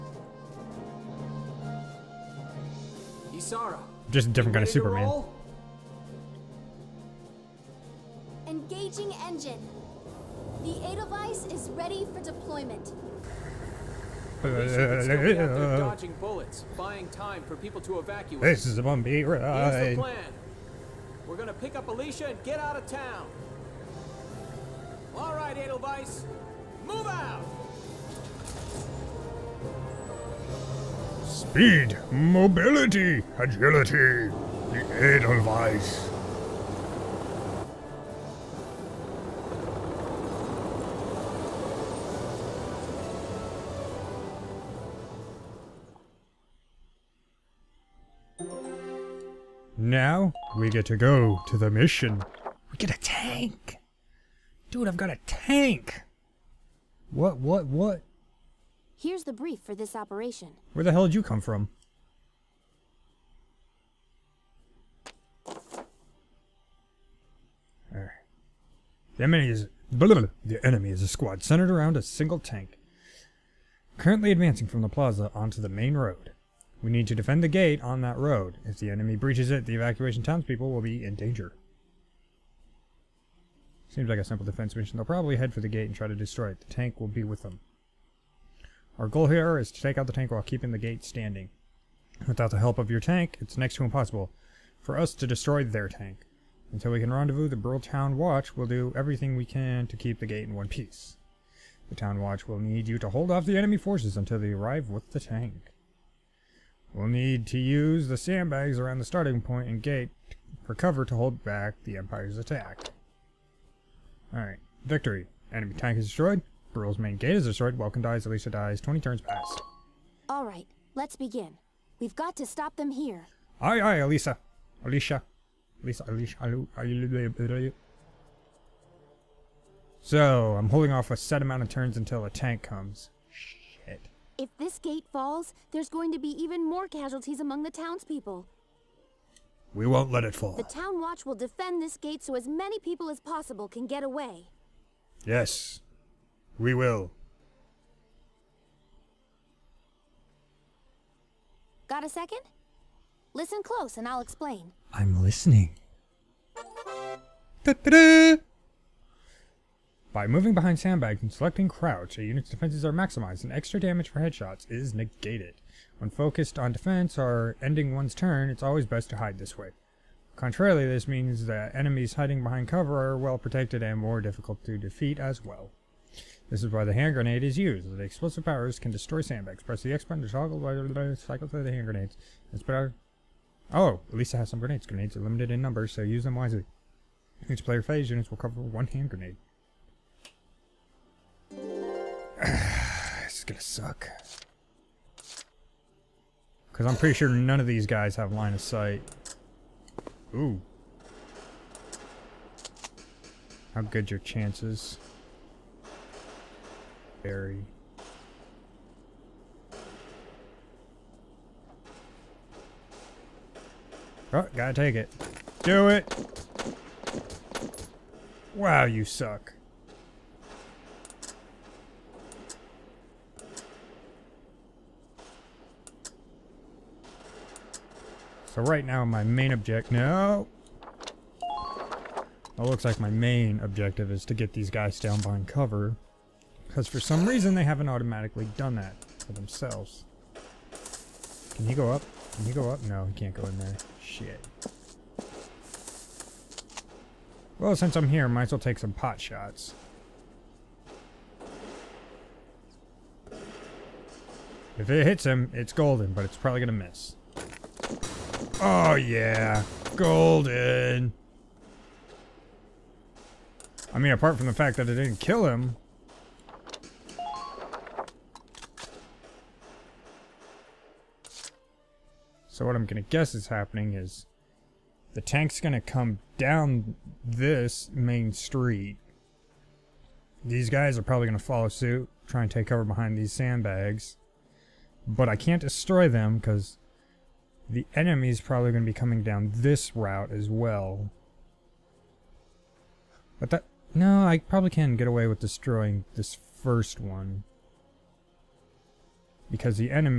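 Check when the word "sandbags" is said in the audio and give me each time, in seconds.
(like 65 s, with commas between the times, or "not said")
108 s, 160 s, 179 s, 283 s.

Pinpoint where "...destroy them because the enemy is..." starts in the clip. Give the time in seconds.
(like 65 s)
285 s.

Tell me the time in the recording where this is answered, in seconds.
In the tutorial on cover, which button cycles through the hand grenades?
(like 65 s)
179 s.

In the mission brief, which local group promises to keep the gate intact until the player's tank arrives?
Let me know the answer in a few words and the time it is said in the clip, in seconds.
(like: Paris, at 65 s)
Bruhl Town Watch, at 97 s.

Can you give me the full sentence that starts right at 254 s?
If it hits him, it's golden, but it's probably going to miss.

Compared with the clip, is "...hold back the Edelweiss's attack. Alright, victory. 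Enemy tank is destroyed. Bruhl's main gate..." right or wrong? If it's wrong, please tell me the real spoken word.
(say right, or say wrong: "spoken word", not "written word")
wrong: "Empire", not "Edelweiss".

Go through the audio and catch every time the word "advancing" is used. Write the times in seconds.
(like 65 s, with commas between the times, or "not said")
74 s.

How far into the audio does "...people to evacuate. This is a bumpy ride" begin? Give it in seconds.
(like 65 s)
17 s.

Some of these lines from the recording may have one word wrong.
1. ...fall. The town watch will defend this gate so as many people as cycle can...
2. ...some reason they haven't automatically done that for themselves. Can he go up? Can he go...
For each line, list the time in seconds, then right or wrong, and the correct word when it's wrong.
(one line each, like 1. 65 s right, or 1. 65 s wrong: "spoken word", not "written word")
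1. 140 s wrong: "possible", not "cycle"
2. 236 s right.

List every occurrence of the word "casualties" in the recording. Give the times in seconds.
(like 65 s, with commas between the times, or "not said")
136 s.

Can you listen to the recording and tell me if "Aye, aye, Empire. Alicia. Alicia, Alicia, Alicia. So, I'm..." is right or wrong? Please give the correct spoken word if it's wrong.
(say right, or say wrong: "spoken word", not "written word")
wrong: "Alicia", not "Empire".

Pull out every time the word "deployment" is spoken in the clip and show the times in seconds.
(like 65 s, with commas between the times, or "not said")
12 s.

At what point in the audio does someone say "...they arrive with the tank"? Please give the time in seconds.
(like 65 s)
104 s.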